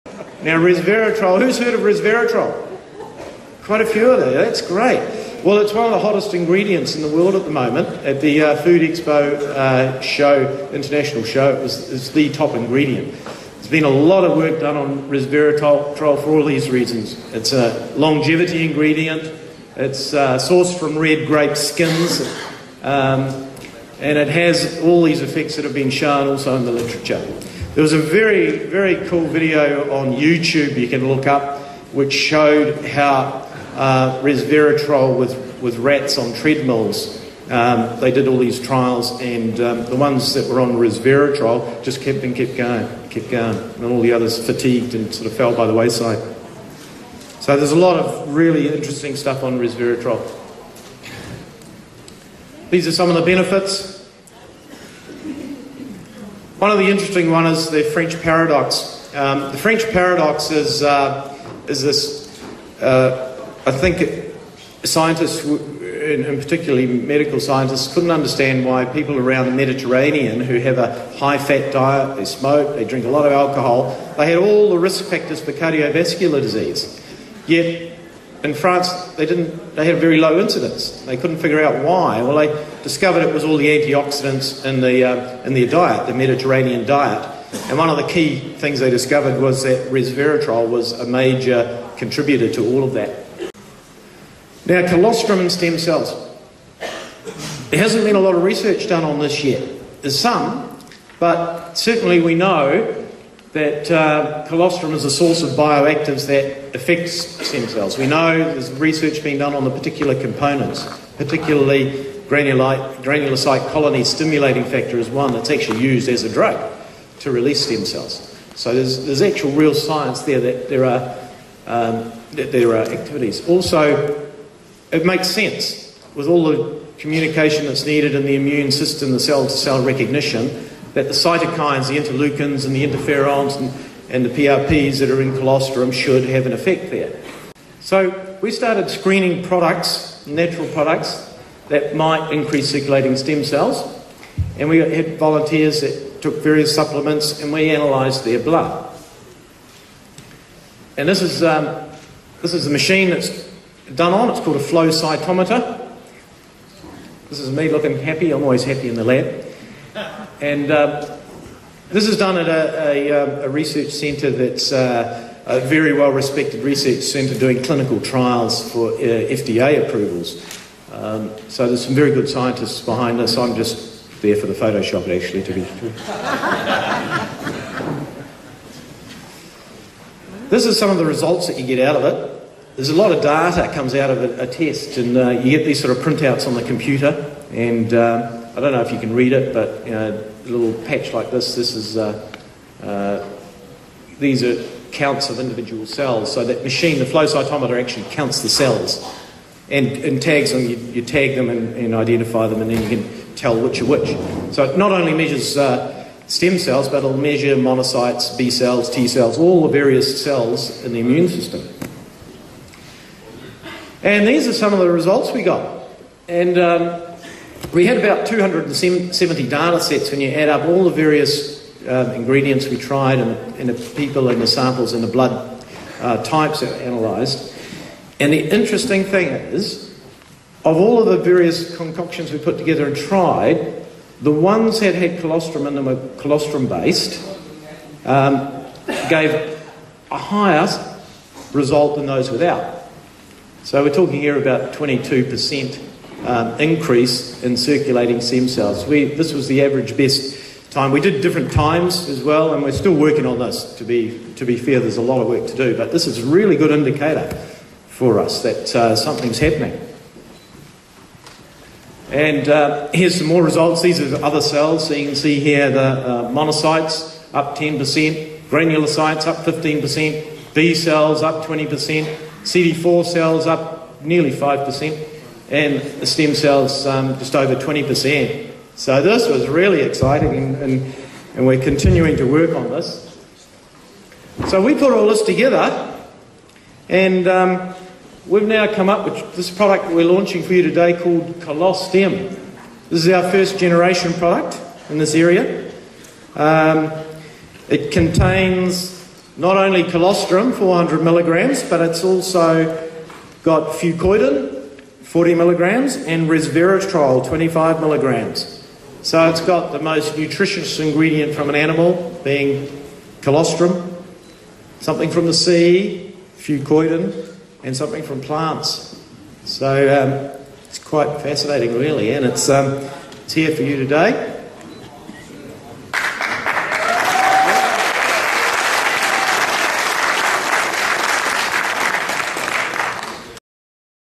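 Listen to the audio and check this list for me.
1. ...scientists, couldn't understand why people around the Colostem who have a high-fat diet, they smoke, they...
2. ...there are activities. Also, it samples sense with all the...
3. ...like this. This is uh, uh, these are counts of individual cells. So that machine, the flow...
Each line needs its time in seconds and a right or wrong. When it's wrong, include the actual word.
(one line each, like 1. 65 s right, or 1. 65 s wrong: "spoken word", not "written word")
1. 67 s wrong: "Mediterranean", not "Colostem"
2. 122 s wrong: "makes", not "samples"
3. 191 s right.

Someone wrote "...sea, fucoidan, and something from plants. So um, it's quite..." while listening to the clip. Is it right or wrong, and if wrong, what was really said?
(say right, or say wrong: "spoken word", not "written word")
right.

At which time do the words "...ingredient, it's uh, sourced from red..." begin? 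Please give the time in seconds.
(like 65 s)
18 s.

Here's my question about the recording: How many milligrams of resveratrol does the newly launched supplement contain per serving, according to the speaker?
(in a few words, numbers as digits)
25 mg.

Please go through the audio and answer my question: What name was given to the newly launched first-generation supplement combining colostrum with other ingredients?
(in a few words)
Colostem.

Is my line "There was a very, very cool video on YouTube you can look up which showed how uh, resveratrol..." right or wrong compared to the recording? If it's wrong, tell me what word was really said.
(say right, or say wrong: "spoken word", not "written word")
right.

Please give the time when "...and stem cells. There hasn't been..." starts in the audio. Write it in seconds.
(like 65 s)
95 s.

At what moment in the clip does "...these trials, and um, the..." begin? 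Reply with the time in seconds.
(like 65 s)
38 s.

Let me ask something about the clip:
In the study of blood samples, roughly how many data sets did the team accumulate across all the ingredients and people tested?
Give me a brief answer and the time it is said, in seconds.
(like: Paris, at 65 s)
270, at 218 s.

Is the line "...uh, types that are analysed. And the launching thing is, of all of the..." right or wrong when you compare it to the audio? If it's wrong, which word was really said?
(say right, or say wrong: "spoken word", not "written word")
wrong: "interesting", not "launching".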